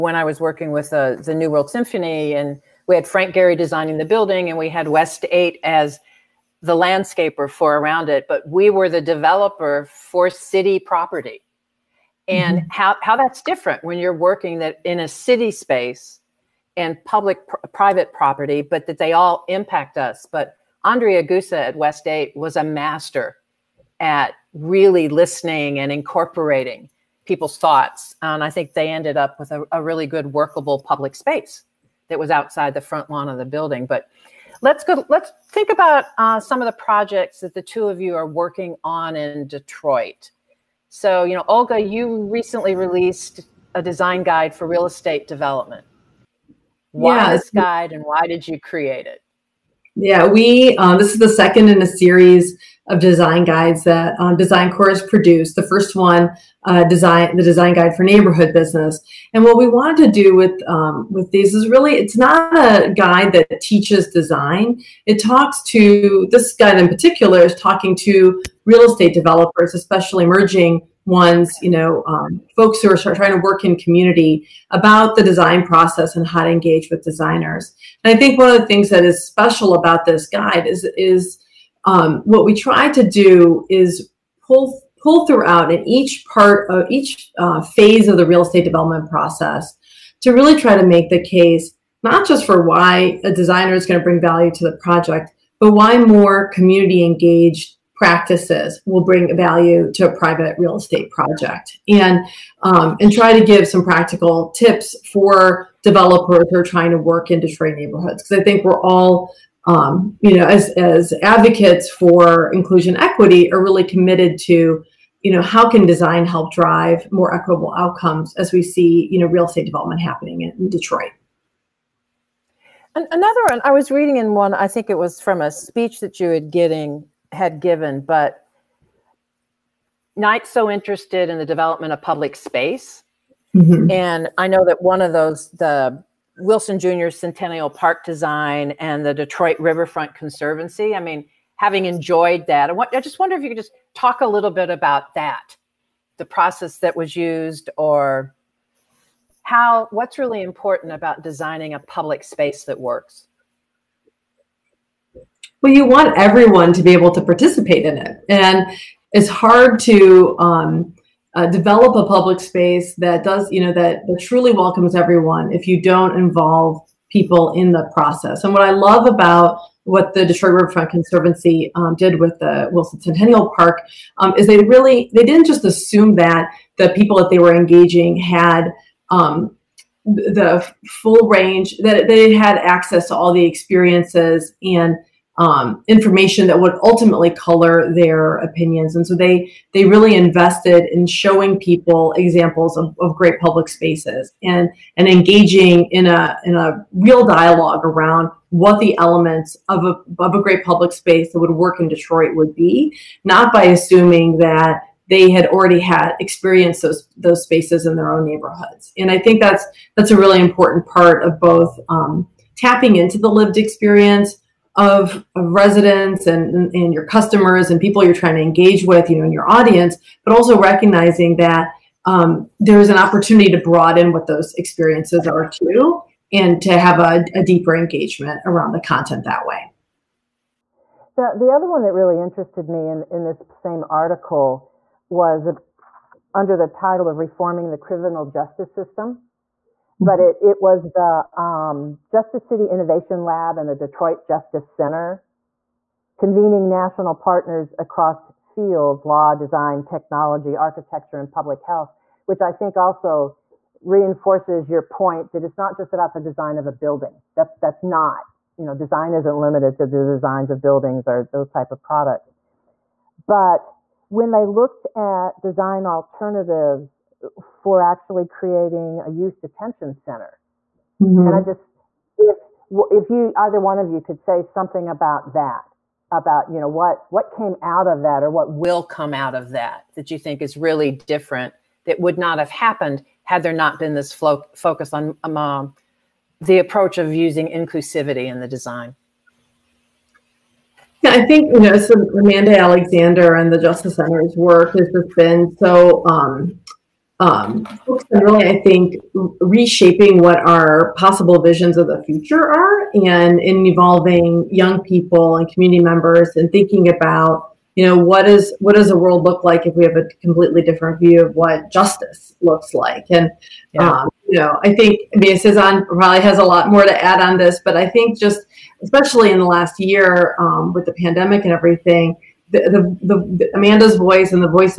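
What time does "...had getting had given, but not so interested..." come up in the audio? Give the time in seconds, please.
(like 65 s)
126 s.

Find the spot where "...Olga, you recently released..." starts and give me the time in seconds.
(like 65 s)
41 s.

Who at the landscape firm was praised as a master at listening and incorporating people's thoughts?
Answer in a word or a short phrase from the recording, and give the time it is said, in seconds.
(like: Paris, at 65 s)
Adriaan Geuze, at 20 s.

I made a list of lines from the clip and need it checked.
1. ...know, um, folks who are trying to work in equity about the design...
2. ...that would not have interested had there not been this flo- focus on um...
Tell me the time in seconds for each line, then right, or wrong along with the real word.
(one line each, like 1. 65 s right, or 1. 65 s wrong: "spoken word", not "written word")
1. 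71 s wrong: "community", not "equity"
2. 281 s wrong: "happened", not "interested".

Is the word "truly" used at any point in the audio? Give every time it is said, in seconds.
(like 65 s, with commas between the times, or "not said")
164 s.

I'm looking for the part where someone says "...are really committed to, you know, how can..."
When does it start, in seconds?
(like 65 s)
113 s.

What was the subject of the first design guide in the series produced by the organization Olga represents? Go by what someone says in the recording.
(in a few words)
neighborhood business.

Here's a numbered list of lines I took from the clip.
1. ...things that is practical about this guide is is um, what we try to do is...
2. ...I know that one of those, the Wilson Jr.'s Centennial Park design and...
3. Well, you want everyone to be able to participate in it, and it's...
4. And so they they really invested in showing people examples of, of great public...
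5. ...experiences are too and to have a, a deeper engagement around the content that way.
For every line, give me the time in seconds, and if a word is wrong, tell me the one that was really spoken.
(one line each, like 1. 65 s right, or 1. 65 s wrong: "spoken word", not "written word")
1. 78 s wrong: "special", not "practical"
2. 134 s right
3. 155 s right
4. 188 s right
5. 224 s right.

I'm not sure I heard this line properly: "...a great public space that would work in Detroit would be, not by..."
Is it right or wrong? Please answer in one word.
right.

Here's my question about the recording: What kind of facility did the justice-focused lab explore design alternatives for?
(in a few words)
youth detention center.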